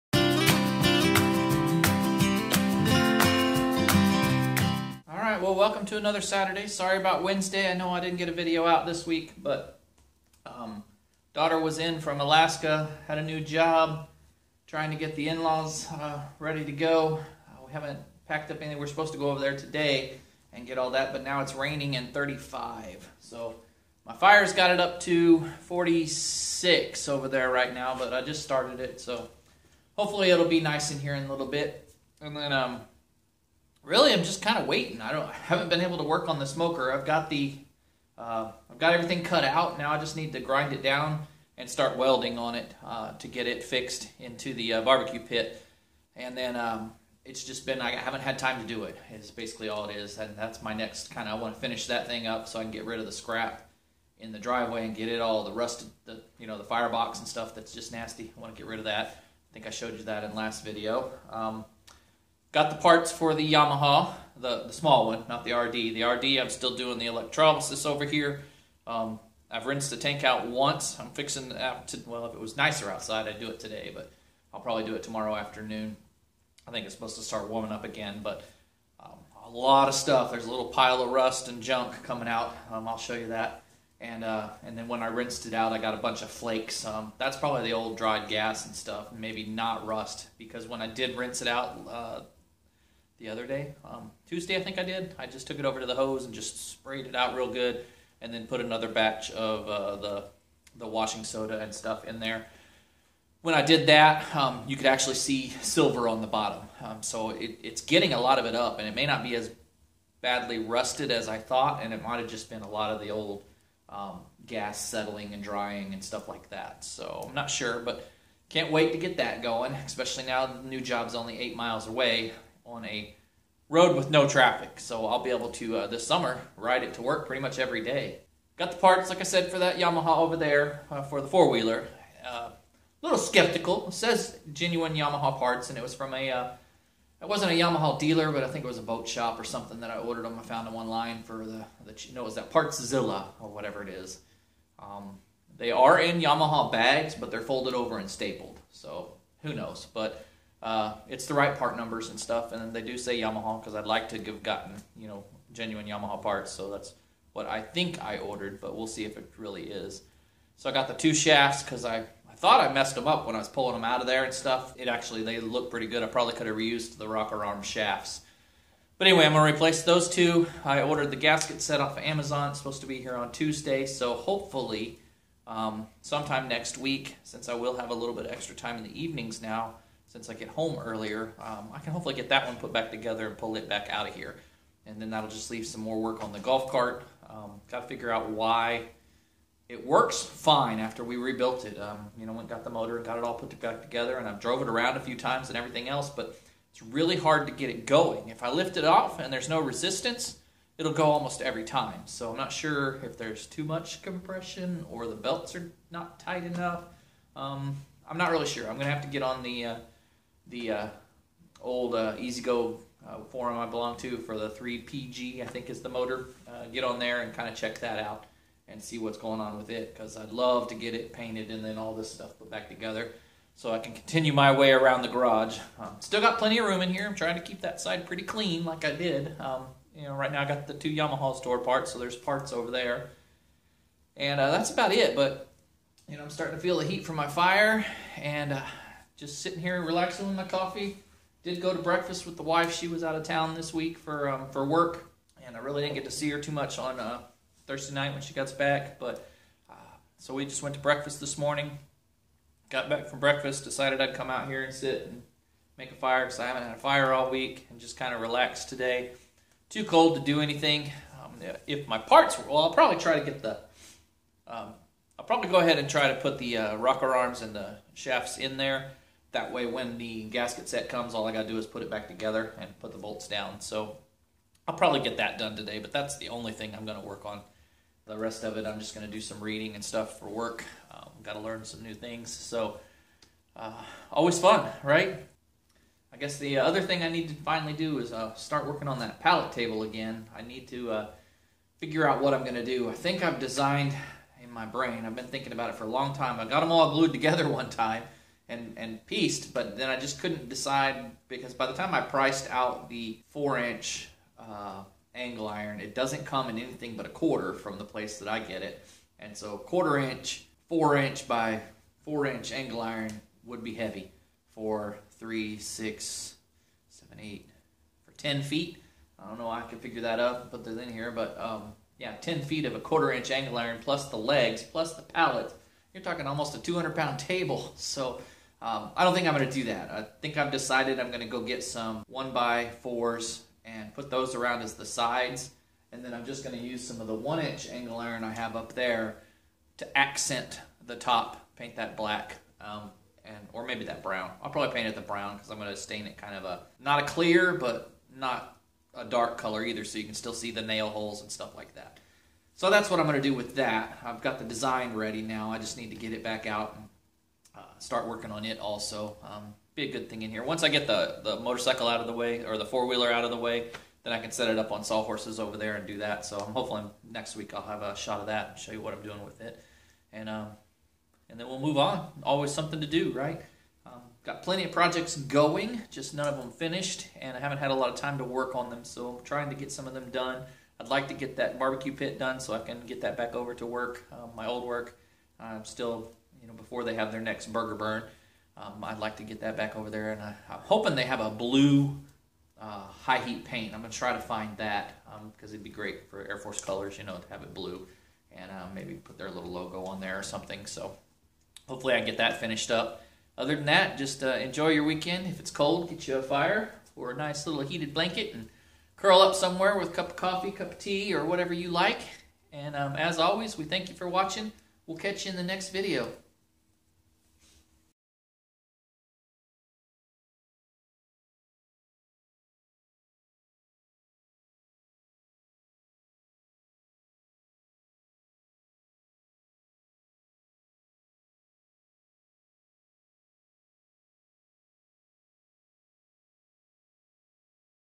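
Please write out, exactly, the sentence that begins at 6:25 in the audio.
I'm still you know, before they have their next burger burn.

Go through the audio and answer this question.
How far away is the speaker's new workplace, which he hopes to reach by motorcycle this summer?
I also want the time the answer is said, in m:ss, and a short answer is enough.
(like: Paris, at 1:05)
8 miles, at 2:01.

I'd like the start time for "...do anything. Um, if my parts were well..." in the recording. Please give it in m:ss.
4:20.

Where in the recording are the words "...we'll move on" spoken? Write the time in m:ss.
6:11.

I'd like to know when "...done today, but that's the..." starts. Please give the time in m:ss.
4:35.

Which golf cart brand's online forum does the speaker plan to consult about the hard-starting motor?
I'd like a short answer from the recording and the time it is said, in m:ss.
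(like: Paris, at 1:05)
EZGO, at 3:32.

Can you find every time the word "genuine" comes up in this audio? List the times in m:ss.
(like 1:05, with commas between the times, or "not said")
2:14, 2:35.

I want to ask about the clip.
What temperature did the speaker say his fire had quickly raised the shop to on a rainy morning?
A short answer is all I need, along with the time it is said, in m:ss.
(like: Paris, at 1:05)
46, at 0:25.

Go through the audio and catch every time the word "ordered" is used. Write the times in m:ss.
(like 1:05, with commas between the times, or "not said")
2:19, 2:38, 2:50.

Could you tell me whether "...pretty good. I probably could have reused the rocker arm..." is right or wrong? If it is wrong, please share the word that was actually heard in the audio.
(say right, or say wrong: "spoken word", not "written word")
right.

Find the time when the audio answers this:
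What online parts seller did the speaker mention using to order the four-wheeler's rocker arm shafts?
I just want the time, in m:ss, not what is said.
2:22.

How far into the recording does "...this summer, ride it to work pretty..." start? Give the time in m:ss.
2:05.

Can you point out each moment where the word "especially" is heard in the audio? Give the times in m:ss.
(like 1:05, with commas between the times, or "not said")
1:59.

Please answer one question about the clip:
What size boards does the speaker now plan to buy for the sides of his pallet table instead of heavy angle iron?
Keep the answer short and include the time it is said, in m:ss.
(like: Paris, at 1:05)
1 by 4s, at 5:32.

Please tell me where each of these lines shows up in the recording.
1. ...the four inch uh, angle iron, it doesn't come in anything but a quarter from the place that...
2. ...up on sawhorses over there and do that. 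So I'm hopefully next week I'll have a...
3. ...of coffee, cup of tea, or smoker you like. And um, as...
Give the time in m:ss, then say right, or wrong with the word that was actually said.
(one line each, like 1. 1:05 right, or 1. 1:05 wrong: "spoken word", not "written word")
1. 5:02 right
2. 6:04 right
3. 6:50 wrong: "whatever", not "smoker".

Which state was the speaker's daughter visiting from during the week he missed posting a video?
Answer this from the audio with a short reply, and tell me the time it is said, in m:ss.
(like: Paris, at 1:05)
Alaska, at 0:12.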